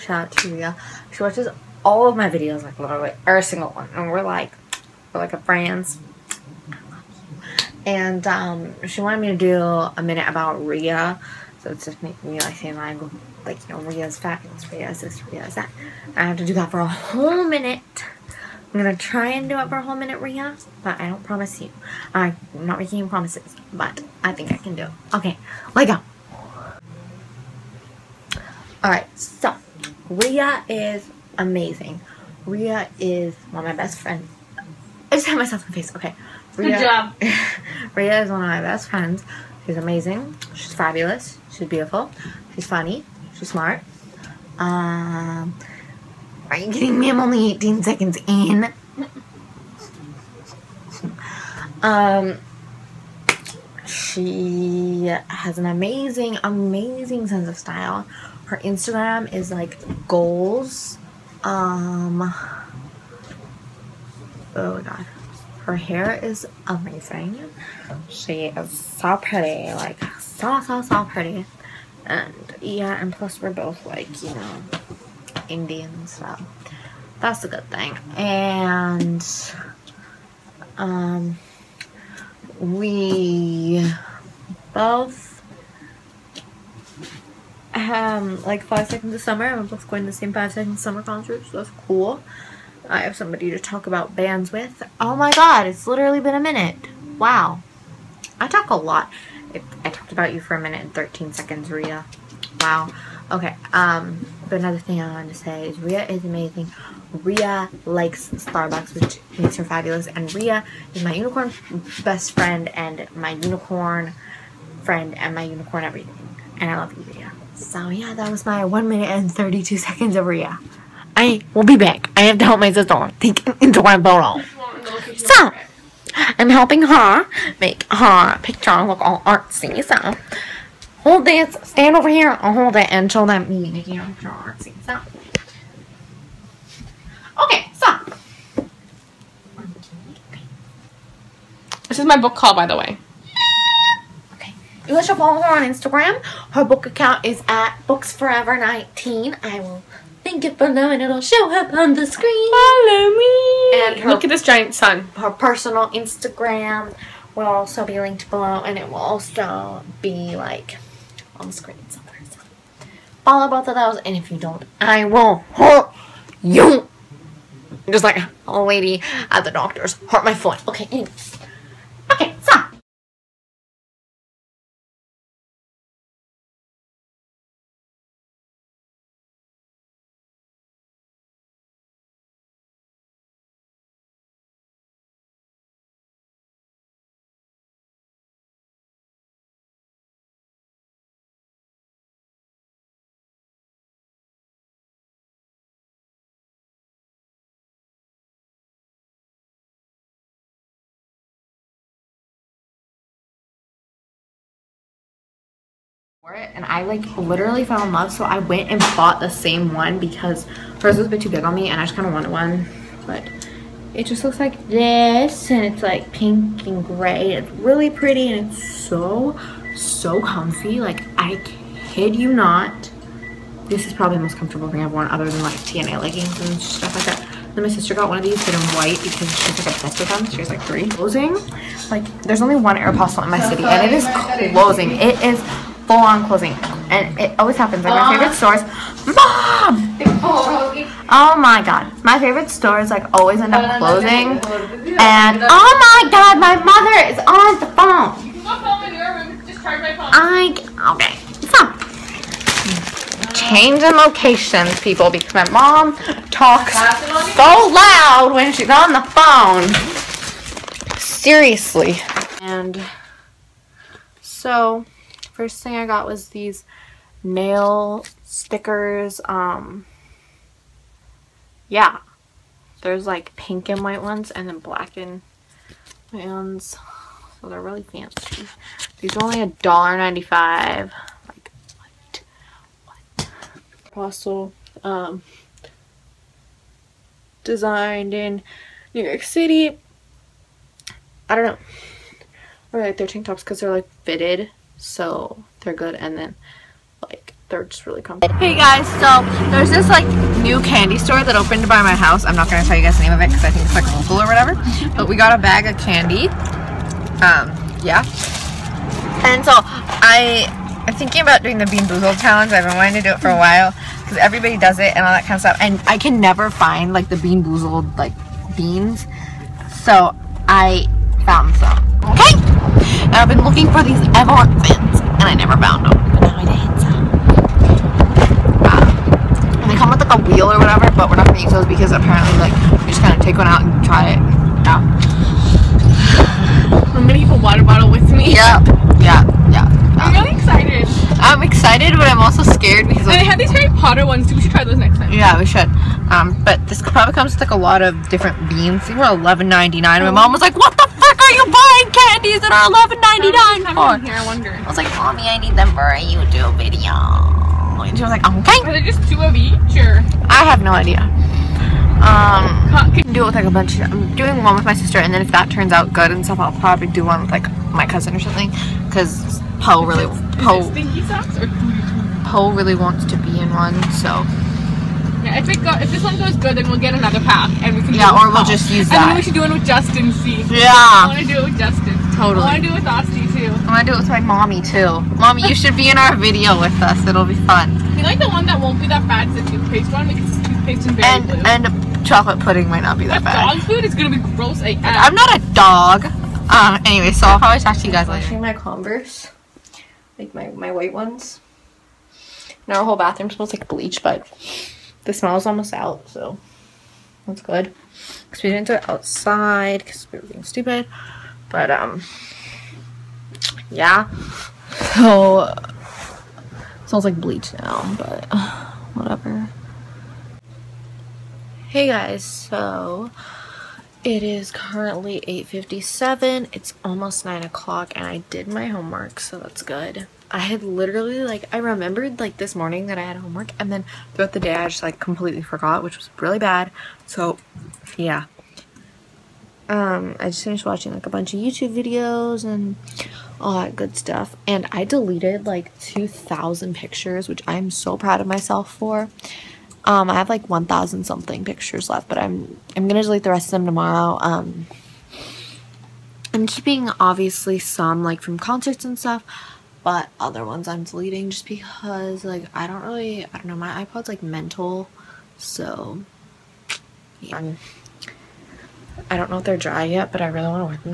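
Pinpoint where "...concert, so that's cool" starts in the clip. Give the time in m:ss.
1:31.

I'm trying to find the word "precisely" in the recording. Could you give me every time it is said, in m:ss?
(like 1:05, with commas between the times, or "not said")
not said.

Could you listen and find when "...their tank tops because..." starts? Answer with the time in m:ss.
4:52.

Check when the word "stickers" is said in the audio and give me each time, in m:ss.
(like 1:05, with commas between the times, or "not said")
4:28.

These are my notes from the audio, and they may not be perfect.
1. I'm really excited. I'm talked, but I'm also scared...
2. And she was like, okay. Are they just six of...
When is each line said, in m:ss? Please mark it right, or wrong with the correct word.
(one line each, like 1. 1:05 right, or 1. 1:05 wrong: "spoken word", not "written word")
1. 5:39 wrong: "excited", not "talked"
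2. 5:57 wrong: "two", not "six".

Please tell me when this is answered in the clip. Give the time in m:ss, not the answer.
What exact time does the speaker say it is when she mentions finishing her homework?
7:05.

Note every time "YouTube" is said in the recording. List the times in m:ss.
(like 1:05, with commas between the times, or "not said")
5:56, 7:21.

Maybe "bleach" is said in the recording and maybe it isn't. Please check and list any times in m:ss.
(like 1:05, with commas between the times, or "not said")
6:43, 6:57.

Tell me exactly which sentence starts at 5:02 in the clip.
I'm not gonna tell you guys the name of it because I think it's like local or whatever.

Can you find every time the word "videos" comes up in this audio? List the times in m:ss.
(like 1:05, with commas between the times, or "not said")
0:02, 5:56, 6:26, 7:21.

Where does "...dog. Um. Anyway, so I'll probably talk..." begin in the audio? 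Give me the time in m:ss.
6:35.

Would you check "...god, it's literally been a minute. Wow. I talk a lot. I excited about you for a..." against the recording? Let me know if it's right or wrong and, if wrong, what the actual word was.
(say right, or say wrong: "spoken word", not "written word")
wrong: "talked", not "excited".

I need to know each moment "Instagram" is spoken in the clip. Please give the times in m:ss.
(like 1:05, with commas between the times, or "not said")
0:58, 2:25, 2:35.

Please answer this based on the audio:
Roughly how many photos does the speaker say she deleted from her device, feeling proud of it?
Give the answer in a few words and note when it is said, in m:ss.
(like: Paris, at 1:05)
2,000, at 7:25.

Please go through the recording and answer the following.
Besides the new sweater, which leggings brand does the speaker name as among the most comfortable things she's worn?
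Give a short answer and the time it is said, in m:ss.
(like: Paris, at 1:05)
TNA, at 3:45.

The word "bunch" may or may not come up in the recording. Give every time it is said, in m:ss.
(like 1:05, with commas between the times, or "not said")
6:03, 7:21.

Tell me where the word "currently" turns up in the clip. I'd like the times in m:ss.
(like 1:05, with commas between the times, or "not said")
7:04.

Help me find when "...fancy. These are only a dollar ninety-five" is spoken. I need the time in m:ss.
4:37.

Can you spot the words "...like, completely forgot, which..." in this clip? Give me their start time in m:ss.
7:14.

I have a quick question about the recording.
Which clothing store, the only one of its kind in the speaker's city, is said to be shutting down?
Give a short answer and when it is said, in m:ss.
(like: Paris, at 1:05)
Aeropostale, at 3:52.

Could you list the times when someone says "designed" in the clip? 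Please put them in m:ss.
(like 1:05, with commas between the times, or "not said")
4:47.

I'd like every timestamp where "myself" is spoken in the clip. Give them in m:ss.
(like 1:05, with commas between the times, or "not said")
0:35, 7:28.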